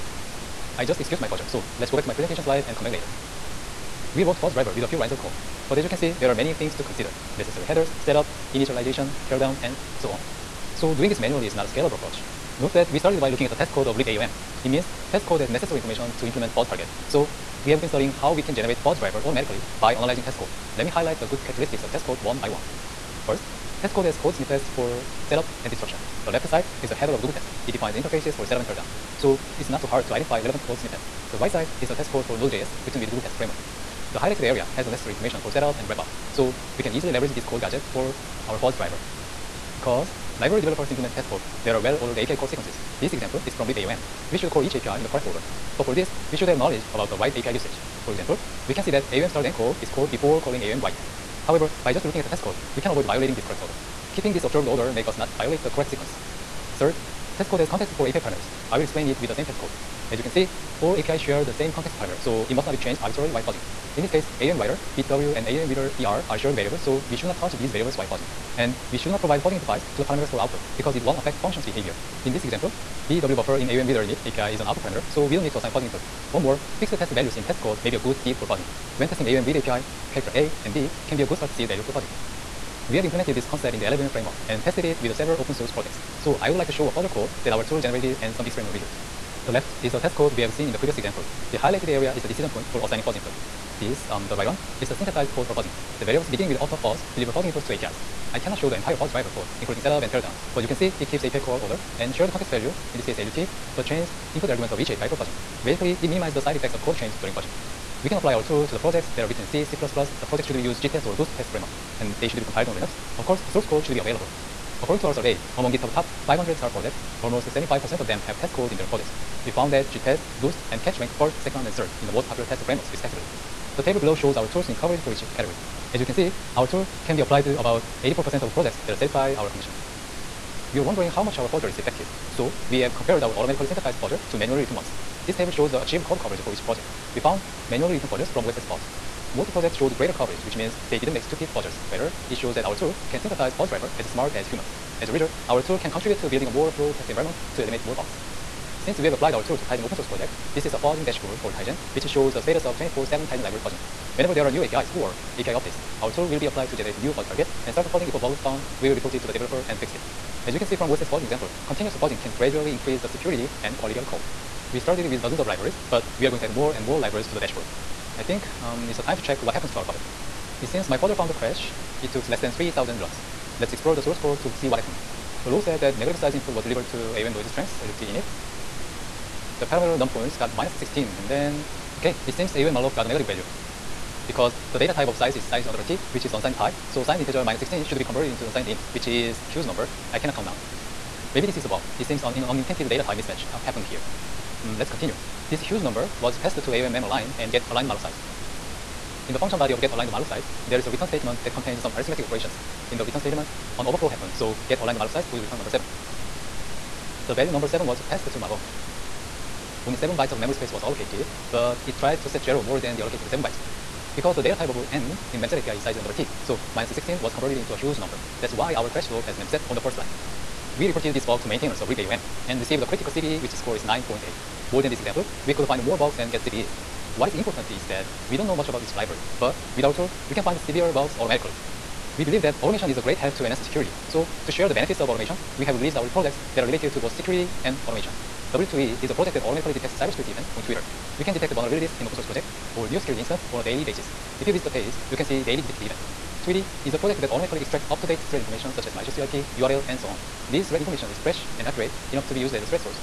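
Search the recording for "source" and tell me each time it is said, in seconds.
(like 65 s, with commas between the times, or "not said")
85 s, 113 s, 149 s, 174 s, 242 s.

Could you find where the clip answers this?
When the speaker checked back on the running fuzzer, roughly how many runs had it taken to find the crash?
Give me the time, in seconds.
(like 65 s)
172 s.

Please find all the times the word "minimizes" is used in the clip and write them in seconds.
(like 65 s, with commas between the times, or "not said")
106 s.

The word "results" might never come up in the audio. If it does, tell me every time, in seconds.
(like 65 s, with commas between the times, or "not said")
88 s, 145 s.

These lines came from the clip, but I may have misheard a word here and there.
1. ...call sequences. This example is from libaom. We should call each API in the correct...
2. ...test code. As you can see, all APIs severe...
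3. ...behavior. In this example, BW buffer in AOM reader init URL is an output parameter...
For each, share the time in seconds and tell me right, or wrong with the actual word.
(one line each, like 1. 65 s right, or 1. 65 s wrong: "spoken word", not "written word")
1. 42 s right
2. 59 s wrong: "share", not "severe"
3. 71 s wrong: "API", not "URL".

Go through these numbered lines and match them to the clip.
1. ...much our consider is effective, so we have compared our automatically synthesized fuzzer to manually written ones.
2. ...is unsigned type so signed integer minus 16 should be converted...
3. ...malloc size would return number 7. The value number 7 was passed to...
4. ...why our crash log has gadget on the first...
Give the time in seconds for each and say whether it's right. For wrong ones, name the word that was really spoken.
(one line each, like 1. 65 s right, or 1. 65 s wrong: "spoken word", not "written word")
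1. 131 s wrong: "fuzzer", not "consider"
2. 186 s right
3. 204 s right
4. 218 s wrong: "memset", not "gadget".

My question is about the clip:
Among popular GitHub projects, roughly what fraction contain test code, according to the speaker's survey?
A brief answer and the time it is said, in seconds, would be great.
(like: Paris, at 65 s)
75%, at 117 s.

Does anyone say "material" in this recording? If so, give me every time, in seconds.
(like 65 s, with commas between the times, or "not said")
not said.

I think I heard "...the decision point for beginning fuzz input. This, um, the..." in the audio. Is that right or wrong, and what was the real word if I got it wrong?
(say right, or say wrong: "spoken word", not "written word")
wrong: "assigning", not "beginning".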